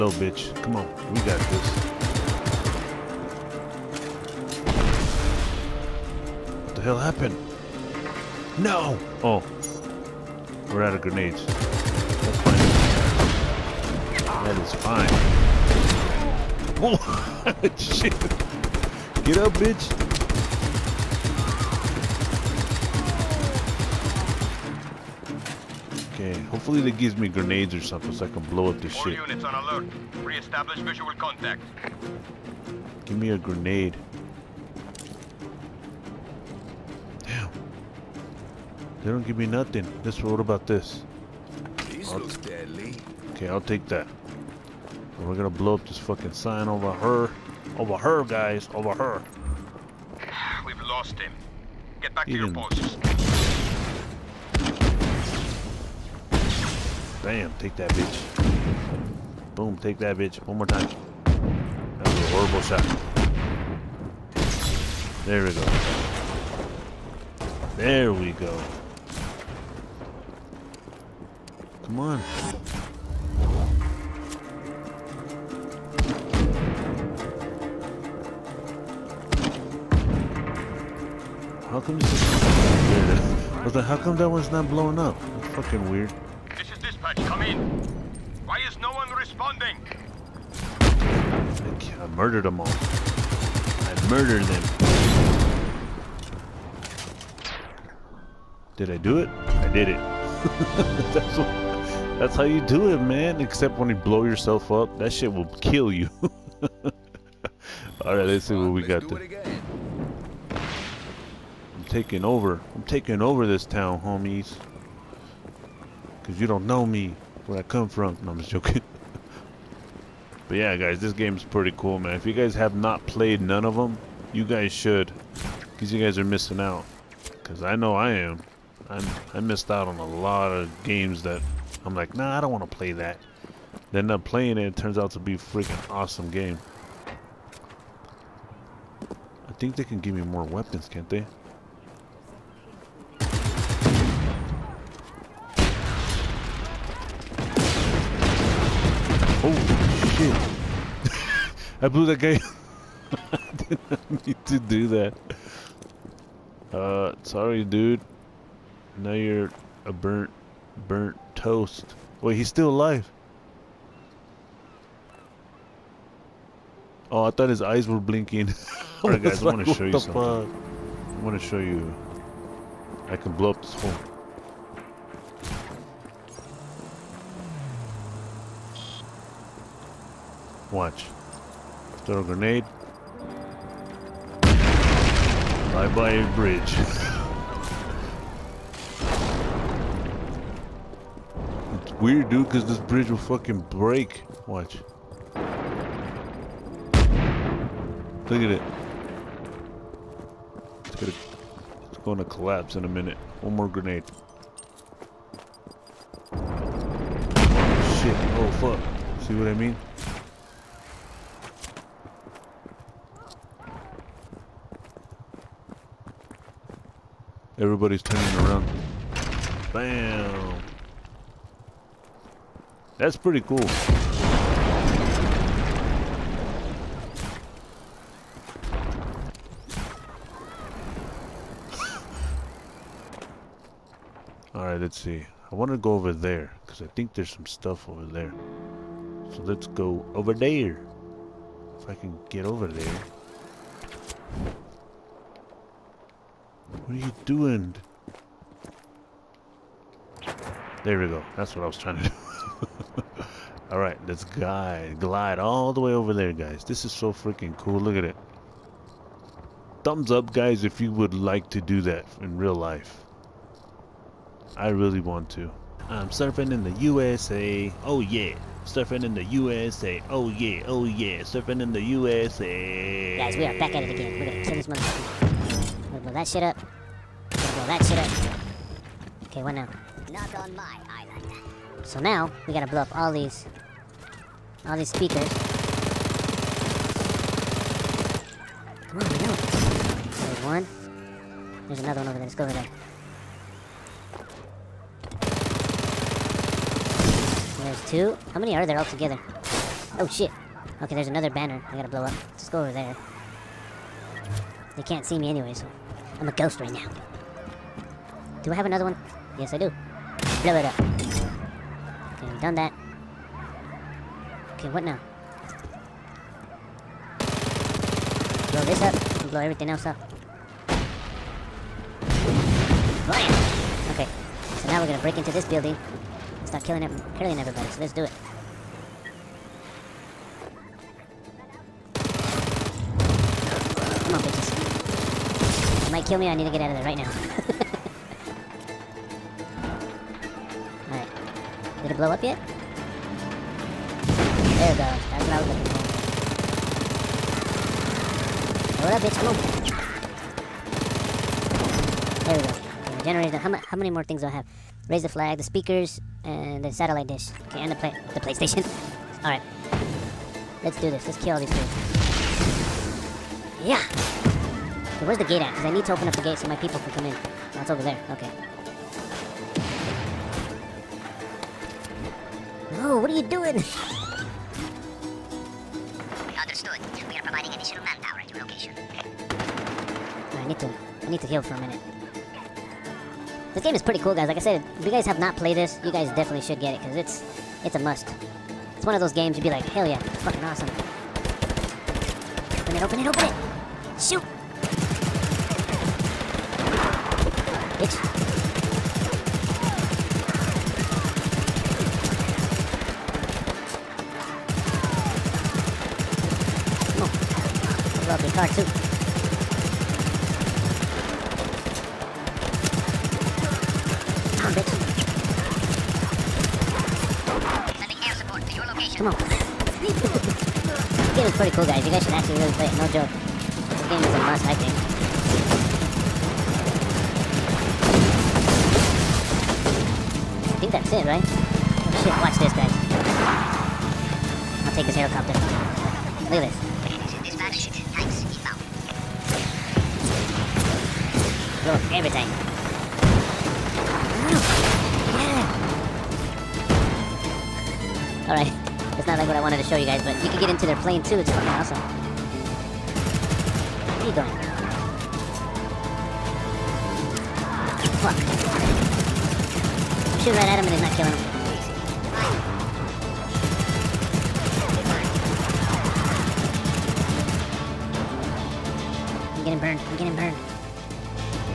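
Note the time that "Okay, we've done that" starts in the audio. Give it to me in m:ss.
5:10.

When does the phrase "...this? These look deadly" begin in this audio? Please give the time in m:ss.
0:40.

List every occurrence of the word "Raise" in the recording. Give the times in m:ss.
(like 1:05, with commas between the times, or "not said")
5:54.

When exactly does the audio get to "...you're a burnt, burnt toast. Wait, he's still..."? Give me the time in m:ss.
2:39.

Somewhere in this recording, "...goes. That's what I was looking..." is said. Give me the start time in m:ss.
5:44.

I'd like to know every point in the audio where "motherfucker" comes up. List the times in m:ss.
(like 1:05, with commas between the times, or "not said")
4:34.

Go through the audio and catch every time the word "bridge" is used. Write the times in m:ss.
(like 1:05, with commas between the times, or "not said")
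3:06, 3:12.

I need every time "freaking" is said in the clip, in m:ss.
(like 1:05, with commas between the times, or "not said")
2:15, 4:17.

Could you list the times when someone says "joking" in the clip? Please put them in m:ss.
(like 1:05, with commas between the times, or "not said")
1:58.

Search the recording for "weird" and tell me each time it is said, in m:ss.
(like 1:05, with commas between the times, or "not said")
1:25, 3:12.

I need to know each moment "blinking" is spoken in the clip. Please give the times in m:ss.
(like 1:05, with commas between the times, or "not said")
2:47.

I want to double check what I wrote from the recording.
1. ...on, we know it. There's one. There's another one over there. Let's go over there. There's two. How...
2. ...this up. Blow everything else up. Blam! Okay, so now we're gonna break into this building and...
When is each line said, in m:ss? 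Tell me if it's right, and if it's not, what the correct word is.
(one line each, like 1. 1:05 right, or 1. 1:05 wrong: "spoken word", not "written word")
1. 4:48 right
2. 5:18 right.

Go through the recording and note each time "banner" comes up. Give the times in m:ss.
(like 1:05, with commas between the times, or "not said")
5:01.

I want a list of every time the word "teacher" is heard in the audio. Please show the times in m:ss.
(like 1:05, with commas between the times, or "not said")
not said.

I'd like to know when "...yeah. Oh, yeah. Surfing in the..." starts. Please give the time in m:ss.
4:30.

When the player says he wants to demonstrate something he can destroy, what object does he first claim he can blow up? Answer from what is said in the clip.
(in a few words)
phone.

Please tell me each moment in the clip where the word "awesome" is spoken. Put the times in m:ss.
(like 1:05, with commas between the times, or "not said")
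2:15, 6:30, 7:31.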